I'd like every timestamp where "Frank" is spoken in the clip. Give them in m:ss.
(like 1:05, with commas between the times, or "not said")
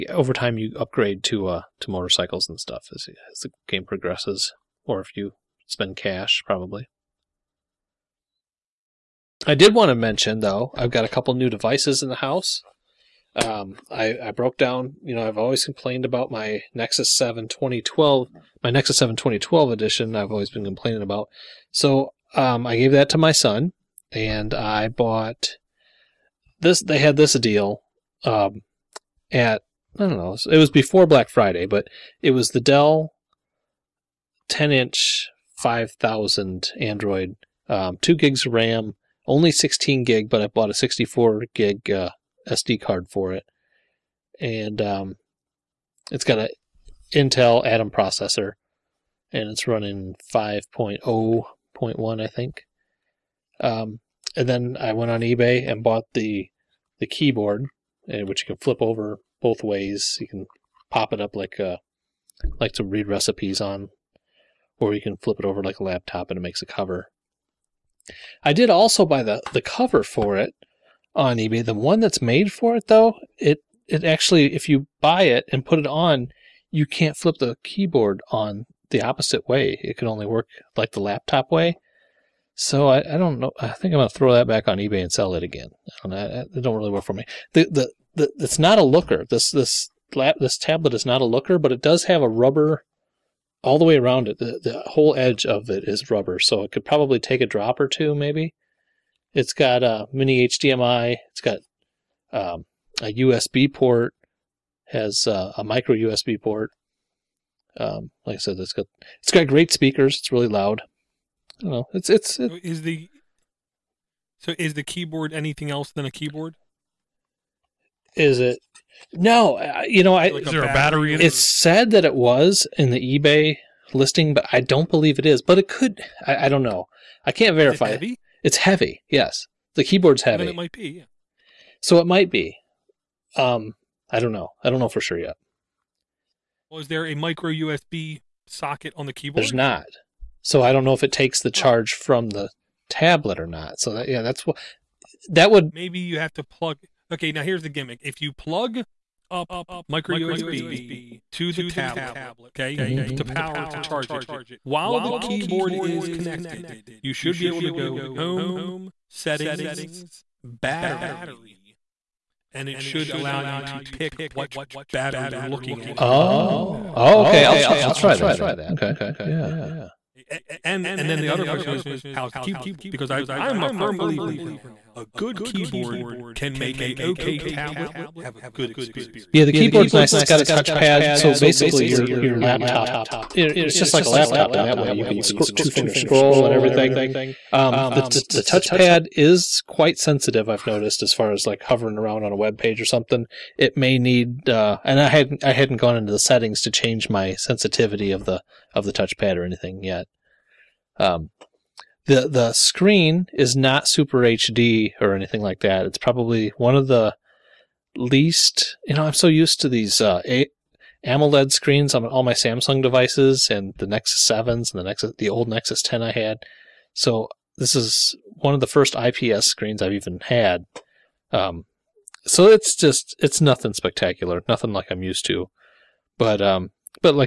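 not said.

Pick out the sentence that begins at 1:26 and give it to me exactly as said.
I don't, it don't really work for me.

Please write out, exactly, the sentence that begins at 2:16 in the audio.
Was there a micro USB socket on the keyboard?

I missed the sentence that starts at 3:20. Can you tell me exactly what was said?
Um, the the screen is not super HD or anything like that.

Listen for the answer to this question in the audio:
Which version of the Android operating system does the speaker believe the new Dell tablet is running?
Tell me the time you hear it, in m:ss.
0:50.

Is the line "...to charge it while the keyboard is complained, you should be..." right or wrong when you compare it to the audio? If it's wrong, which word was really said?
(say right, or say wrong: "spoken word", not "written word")
wrong: "connected", not "complained".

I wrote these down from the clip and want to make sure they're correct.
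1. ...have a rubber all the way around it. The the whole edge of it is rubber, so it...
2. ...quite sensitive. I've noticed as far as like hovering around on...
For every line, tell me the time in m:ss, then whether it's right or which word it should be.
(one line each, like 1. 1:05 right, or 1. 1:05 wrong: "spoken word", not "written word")
1. 1:32 right
2. 3:09 right.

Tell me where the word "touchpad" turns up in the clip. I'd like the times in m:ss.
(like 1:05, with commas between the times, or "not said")
3:00, 3:08, 3:18.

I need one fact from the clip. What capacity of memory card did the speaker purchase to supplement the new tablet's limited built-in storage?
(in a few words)
64 gig.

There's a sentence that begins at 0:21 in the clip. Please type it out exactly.
So um, I gave that to my son, and I bought this.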